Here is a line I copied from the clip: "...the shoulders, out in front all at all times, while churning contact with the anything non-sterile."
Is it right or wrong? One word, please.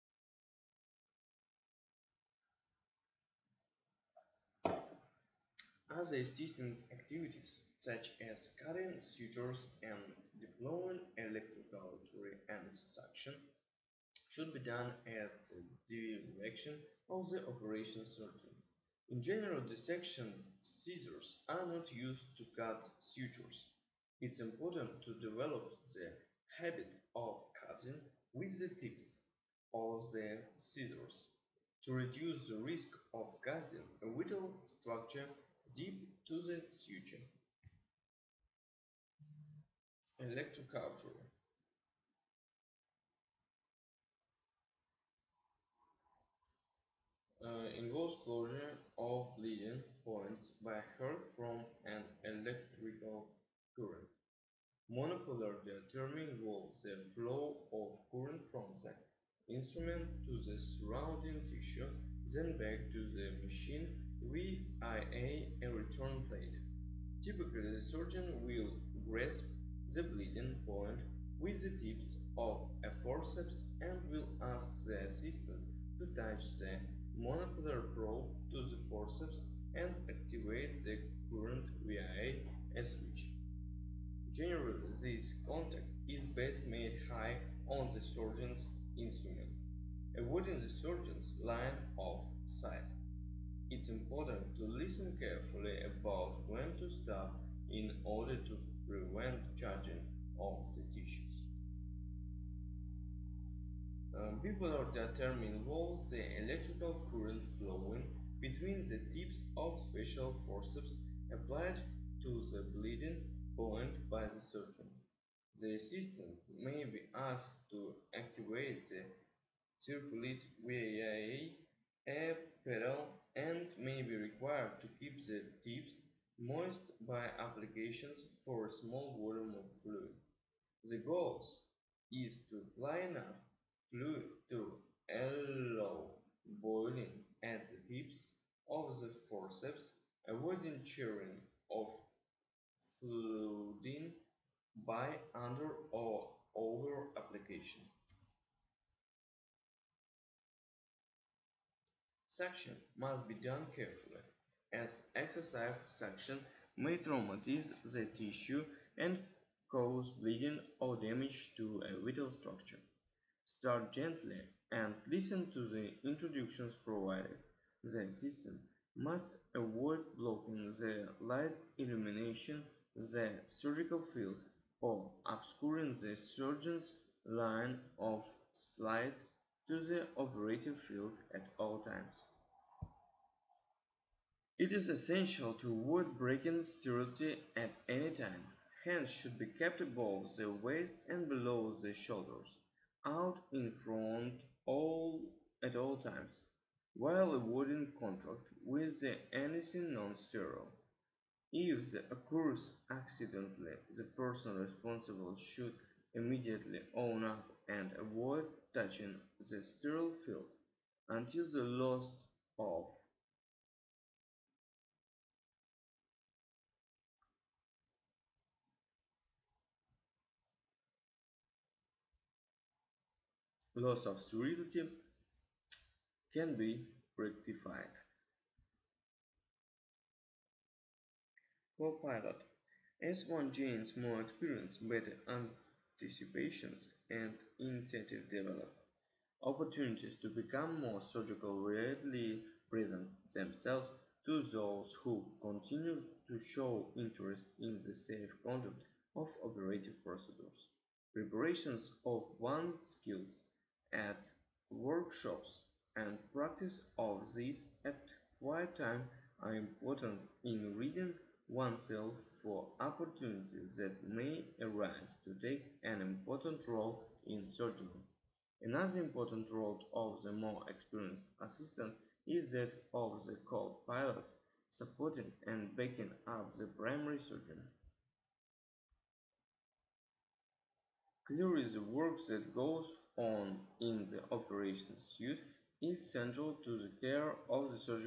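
wrong.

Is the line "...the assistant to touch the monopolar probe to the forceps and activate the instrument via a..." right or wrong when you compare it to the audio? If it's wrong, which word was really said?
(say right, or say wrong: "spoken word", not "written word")
wrong: "current", not "instrument".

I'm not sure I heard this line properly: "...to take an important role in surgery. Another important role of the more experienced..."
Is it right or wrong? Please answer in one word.
right.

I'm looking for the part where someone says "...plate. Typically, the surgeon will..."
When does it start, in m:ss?
1:06.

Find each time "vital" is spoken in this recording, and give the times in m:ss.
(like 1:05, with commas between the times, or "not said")
0:34, 2:42.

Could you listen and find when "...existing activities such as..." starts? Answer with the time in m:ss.
0:06.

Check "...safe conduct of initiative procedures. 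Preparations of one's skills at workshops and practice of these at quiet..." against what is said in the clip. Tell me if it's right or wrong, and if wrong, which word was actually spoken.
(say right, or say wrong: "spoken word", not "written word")
wrong: "operative", not "initiative".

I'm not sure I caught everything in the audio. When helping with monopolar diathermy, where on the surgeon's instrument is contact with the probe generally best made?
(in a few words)
high.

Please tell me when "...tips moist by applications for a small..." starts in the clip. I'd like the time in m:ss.
2:05.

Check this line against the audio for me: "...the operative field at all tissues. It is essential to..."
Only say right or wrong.
wrong.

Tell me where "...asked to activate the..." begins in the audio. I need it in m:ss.
1:57.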